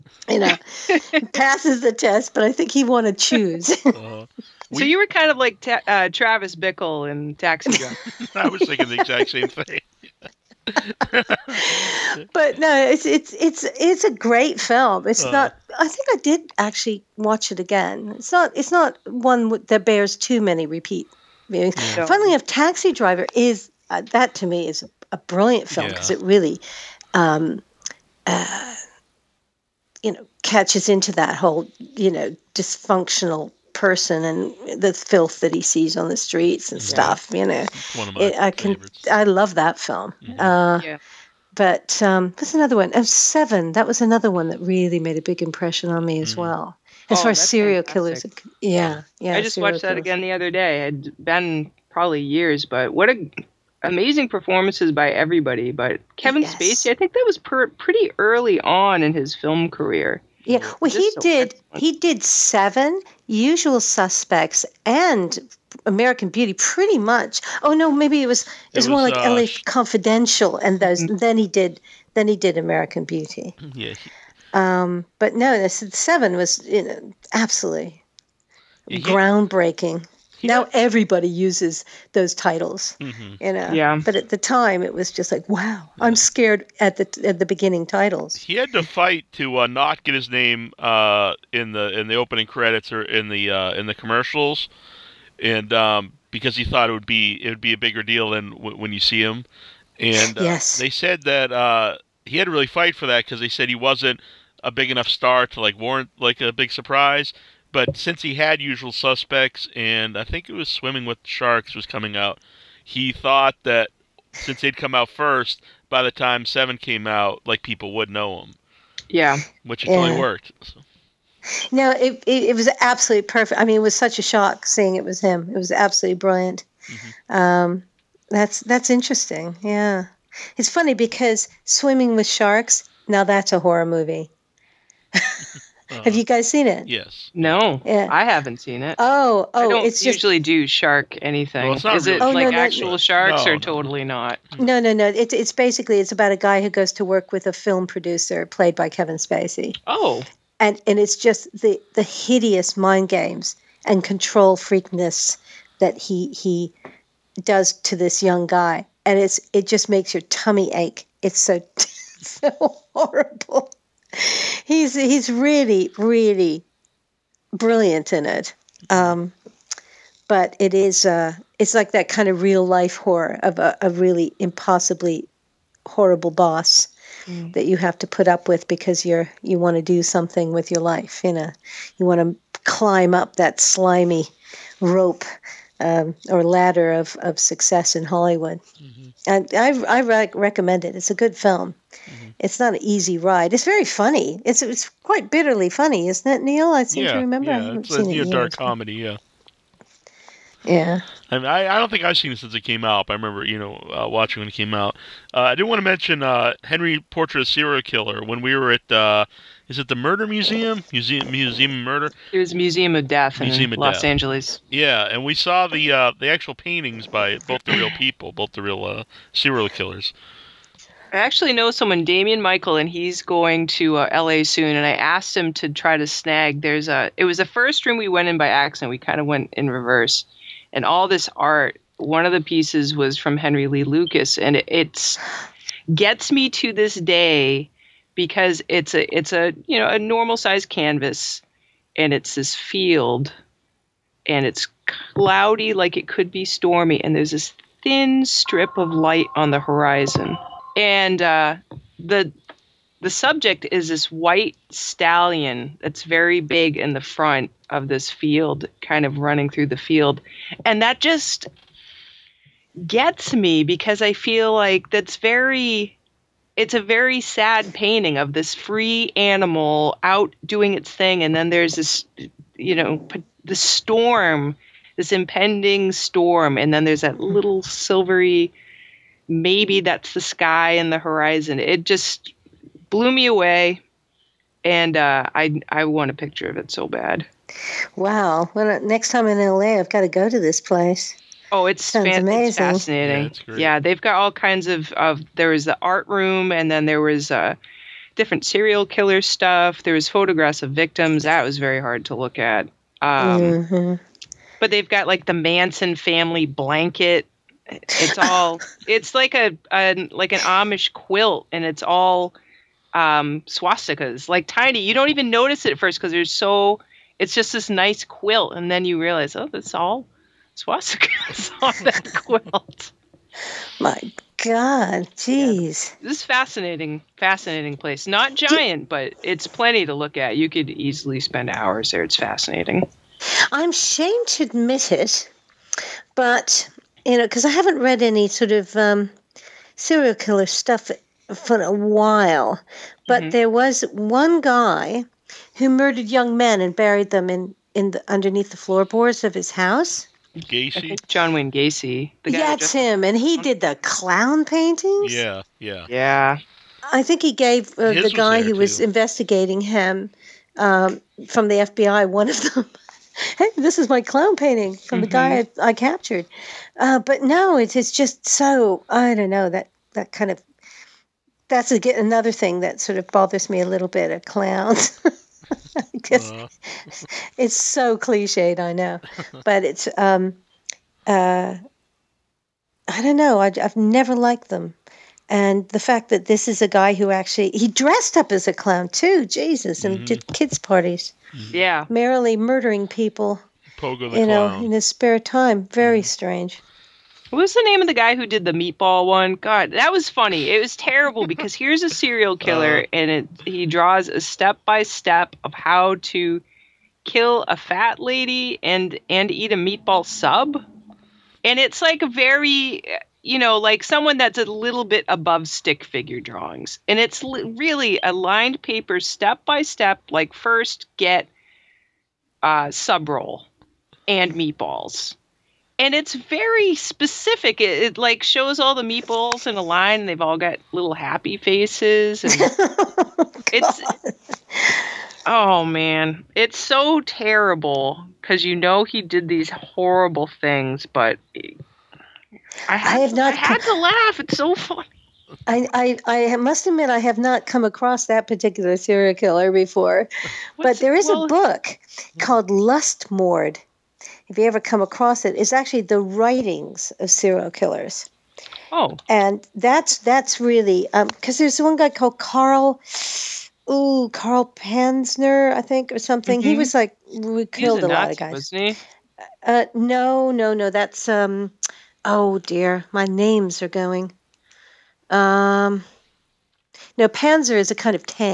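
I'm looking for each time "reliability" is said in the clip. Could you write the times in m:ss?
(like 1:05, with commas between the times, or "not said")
not said.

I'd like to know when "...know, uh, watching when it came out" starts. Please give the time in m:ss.
3:23.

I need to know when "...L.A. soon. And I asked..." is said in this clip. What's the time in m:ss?
3:44.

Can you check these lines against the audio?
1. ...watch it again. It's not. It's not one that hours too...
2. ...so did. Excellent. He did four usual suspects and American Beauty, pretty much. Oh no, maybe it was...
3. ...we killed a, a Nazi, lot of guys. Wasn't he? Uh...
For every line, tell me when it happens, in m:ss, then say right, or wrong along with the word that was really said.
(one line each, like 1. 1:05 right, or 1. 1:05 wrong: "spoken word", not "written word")
1. 0:17 wrong: "bears", not "hours"
2. 1:01 wrong: "seven", not "four"
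3. 7:47 right.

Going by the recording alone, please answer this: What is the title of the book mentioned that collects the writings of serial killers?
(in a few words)
Lustmord.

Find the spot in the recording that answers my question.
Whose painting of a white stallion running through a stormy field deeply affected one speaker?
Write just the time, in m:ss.
3:53.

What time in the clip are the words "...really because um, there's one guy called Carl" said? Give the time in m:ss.
7:40.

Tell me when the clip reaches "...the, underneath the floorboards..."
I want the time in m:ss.
5:47.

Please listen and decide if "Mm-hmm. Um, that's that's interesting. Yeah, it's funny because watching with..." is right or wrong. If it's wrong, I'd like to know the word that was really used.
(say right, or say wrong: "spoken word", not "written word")
wrong: "swimming", not "watching".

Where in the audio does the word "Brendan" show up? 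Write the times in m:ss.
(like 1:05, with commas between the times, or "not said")
not said.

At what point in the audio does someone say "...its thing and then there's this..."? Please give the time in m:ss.
4:30.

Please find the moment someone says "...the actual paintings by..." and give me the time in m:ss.
3:36.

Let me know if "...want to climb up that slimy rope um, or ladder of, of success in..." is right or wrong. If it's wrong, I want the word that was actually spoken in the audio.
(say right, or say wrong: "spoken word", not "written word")
right.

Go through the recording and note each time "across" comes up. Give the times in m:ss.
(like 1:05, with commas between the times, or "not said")
7:27, 7:34.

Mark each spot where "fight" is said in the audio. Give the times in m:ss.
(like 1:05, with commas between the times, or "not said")
1:28, 1:42.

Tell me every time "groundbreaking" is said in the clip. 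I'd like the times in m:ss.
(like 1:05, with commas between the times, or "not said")
1:19.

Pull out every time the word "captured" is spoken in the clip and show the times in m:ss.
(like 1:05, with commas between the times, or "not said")
6:05.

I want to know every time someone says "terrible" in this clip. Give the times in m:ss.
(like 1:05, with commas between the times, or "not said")
6:40, 7:17.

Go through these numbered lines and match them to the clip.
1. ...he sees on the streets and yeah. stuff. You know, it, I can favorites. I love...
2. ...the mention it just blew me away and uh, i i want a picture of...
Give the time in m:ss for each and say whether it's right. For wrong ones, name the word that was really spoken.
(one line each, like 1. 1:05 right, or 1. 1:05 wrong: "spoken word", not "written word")
1. 0:35 right
2. 4:40 wrong: "horizon", not "mention".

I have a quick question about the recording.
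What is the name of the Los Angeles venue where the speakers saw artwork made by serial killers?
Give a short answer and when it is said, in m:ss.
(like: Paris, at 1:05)
Museum of Death, at 3:32.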